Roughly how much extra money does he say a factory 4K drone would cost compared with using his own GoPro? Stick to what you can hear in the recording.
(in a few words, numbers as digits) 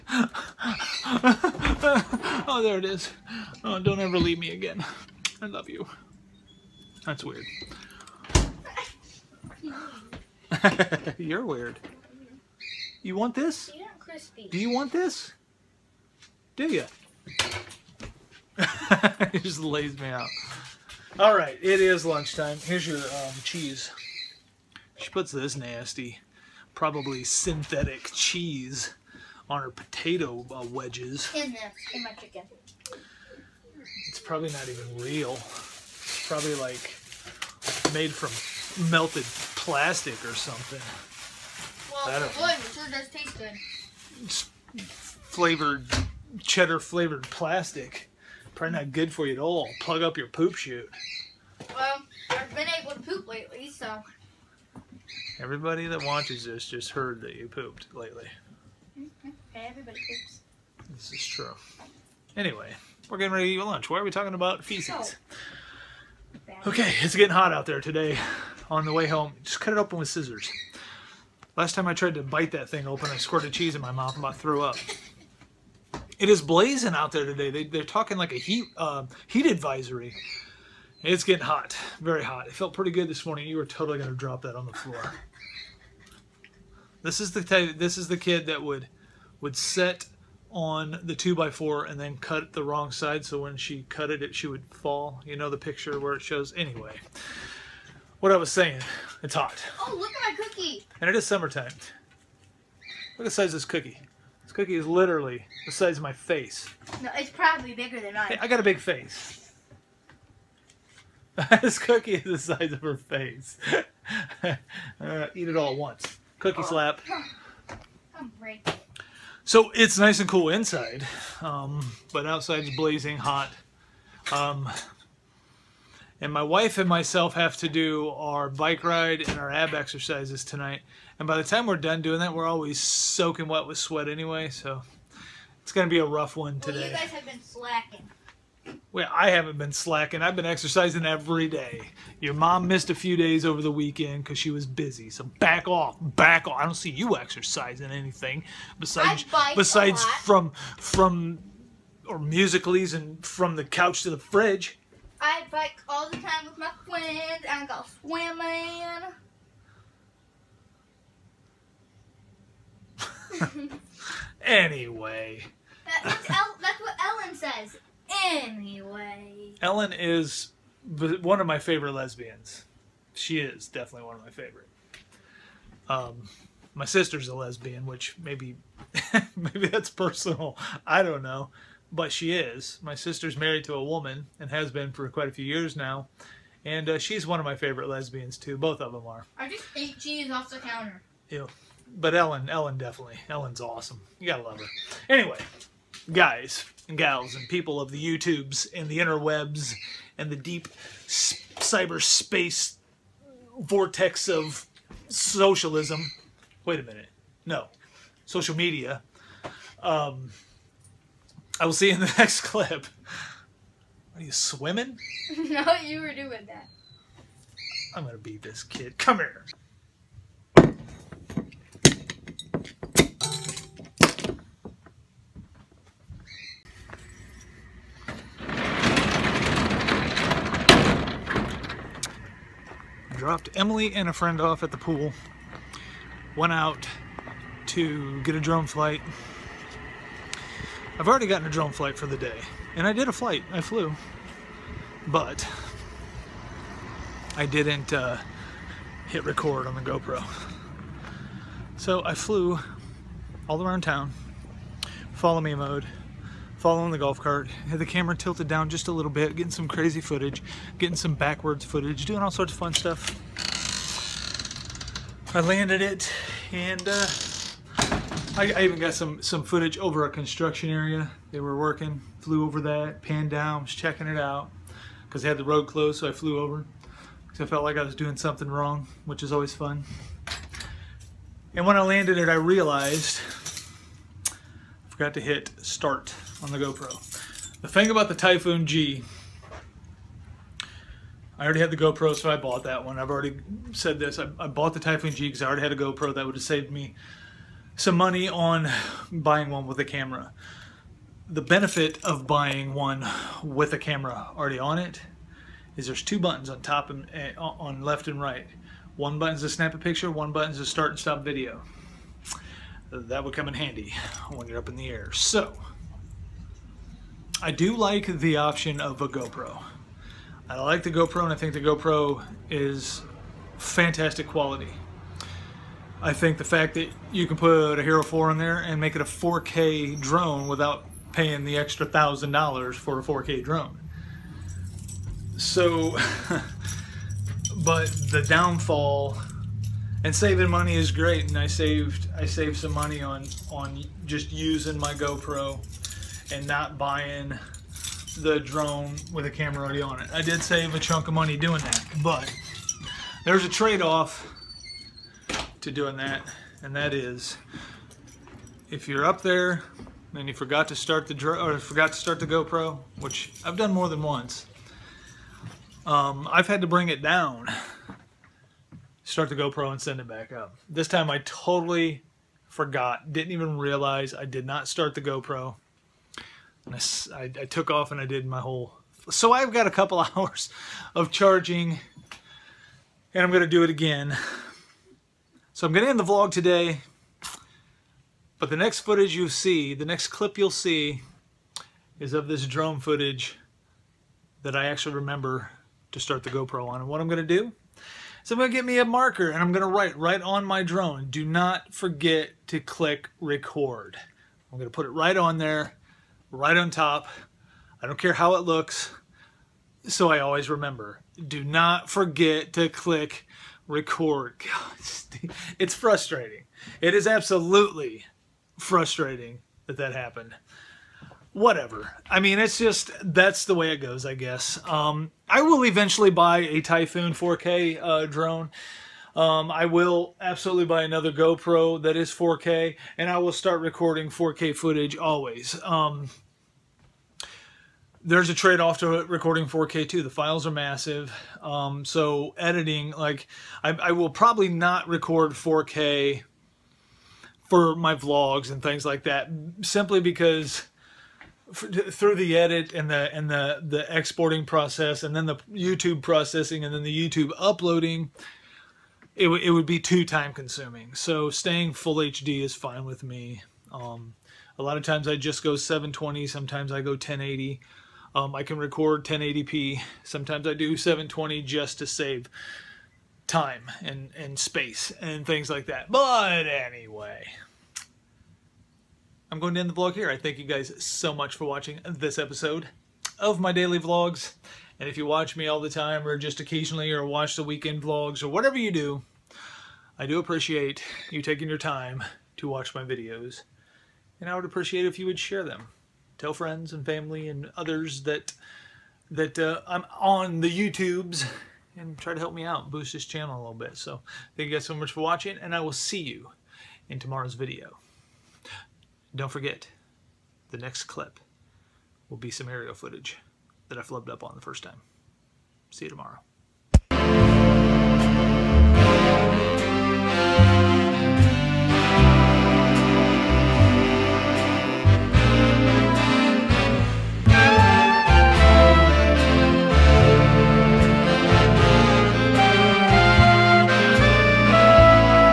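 $1,000.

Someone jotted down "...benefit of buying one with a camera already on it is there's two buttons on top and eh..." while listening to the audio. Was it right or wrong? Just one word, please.
right.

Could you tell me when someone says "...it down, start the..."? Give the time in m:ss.
6:06.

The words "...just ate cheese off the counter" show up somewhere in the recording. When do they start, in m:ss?
3:09.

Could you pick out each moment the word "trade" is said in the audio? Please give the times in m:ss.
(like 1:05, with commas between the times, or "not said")
5:53, 7:18.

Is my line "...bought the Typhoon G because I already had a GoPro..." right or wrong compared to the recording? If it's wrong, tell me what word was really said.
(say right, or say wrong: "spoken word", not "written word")
right.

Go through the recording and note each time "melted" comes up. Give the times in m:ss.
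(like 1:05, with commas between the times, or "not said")
0:38.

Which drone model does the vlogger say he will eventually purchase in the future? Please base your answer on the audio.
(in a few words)
Typhoon 4K.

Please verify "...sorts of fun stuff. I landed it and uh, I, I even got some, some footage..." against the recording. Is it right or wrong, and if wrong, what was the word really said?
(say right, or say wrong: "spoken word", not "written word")
right.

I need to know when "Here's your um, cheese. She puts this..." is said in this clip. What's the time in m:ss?
0:22.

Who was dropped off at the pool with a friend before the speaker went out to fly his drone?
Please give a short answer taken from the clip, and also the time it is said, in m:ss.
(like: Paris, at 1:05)
Emily, at 3:53.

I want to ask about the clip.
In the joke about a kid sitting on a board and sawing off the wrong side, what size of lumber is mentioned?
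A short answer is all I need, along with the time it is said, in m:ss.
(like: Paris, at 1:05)
2 by 4, at 1:31.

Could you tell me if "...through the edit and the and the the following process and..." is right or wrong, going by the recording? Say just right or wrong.
wrong.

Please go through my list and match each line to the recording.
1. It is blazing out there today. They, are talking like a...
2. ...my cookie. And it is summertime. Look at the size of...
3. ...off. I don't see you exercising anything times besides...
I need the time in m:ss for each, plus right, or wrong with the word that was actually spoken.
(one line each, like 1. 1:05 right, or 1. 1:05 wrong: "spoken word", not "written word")
1. 1:16 right
2. 1:40 right
3. 2:26 wrong: "besides", not "times".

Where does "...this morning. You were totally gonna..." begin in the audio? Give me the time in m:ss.
1:23.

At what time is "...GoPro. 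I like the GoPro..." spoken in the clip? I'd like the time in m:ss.
5:19.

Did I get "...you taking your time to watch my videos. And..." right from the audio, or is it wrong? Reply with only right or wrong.
right.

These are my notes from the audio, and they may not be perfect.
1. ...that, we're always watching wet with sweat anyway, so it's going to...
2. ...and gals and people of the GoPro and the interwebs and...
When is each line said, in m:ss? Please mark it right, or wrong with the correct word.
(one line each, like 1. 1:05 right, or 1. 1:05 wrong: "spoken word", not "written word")
1. 2:12 wrong: "soaking", not "watching"
2. 3:16 wrong: "YouTubes", not "GoPro".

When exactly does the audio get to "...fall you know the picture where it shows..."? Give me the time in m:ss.
1:34.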